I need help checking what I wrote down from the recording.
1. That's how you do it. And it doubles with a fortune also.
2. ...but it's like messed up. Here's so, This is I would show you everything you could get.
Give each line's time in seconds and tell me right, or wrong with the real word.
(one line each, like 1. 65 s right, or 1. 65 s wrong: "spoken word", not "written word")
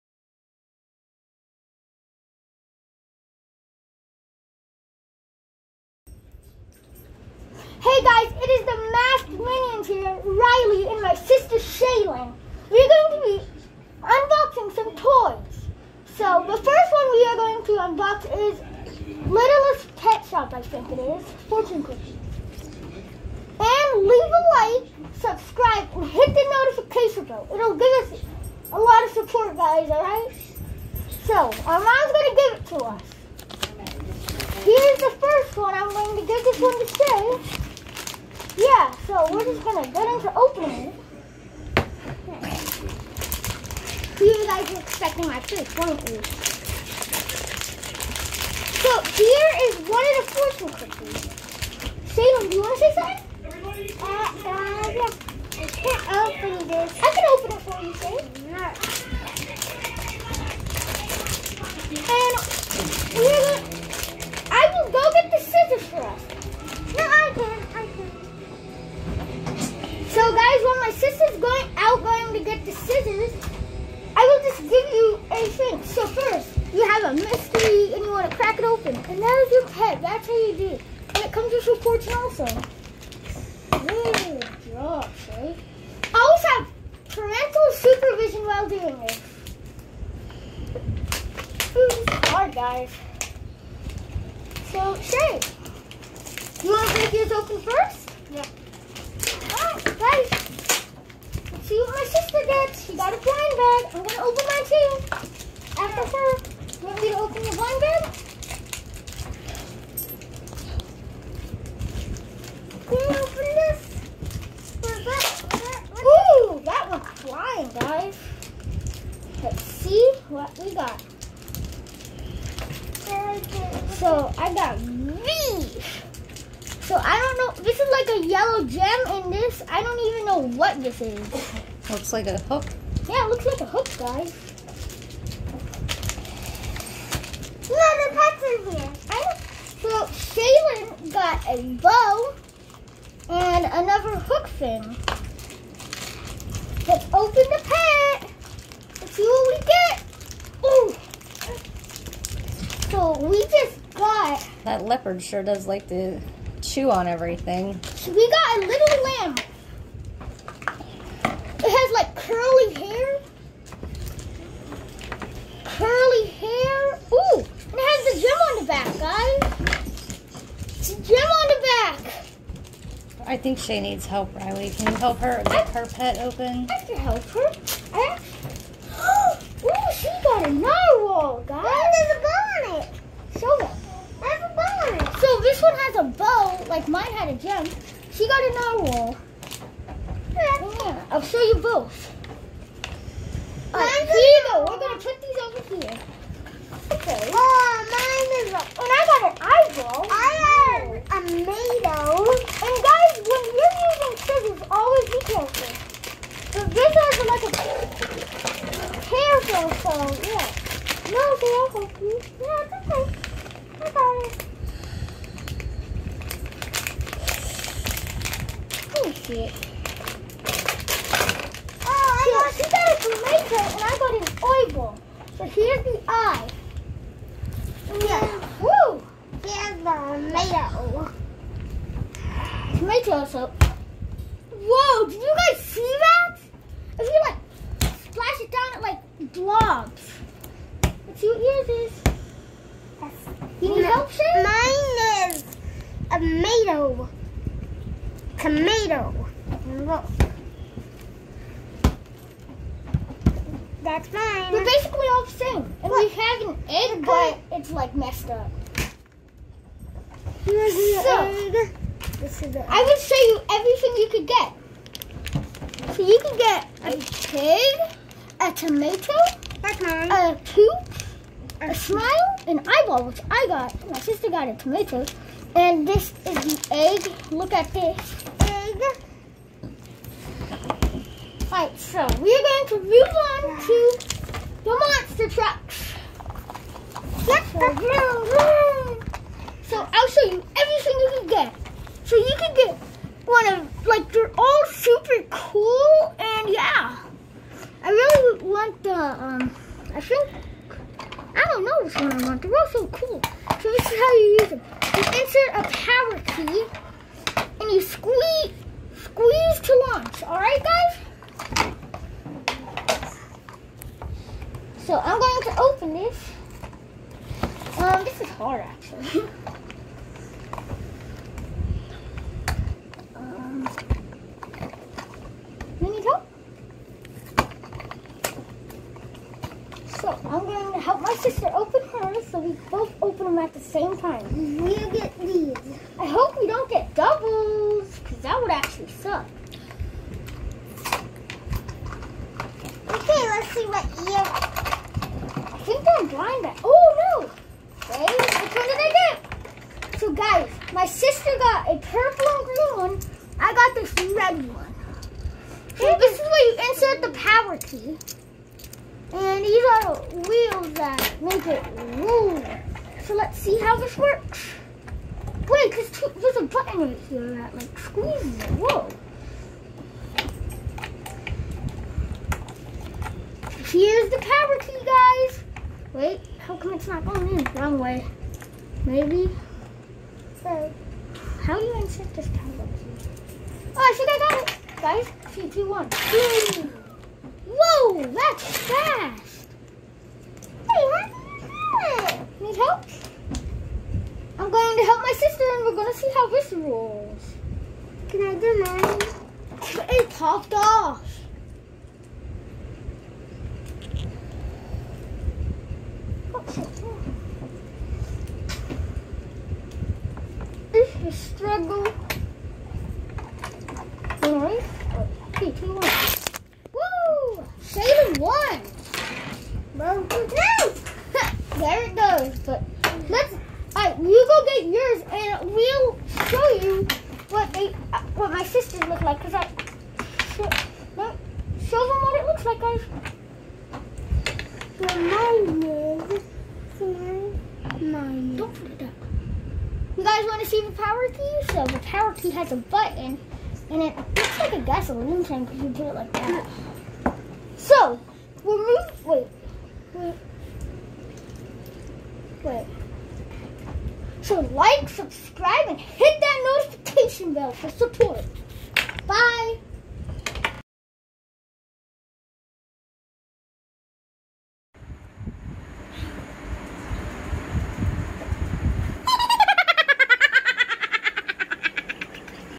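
1. 80 s wrong: "comes", not "doubles"
2. 257 s right.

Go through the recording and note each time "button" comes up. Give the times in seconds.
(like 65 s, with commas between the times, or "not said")
366 s, 442 s.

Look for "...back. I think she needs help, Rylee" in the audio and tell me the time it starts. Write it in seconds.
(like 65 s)
172 s.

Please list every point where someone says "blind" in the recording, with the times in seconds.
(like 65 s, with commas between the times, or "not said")
103 s, 346 s.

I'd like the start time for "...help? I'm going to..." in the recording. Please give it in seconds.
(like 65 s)
392 s.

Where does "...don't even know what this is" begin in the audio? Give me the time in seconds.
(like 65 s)
129 s.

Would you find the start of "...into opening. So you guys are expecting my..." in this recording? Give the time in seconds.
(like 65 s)
40 s.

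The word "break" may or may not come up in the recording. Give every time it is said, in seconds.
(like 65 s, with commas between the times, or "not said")
96 s.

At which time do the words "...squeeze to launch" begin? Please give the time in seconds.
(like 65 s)
309 s.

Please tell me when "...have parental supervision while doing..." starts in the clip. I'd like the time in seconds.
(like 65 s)
86 s.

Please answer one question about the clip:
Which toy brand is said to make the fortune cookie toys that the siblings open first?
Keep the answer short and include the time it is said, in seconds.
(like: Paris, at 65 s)
Littlest Pet Shop, at 19 s.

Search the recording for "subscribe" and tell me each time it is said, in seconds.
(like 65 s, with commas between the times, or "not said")
25 s, 454 s.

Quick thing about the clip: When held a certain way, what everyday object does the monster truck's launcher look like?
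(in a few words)
gasoline tank.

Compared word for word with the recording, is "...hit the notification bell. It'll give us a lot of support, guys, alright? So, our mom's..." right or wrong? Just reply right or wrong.
right.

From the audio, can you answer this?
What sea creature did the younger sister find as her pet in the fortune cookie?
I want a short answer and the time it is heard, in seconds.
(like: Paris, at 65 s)
narwhal, at 188 s.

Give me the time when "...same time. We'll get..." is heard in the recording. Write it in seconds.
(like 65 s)
333 s.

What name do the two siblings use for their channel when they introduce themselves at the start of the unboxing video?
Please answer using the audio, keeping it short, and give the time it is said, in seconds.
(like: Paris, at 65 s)
Masked Minions, at 8 s.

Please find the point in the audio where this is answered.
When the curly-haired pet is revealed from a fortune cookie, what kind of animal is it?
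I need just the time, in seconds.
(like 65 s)
159 s.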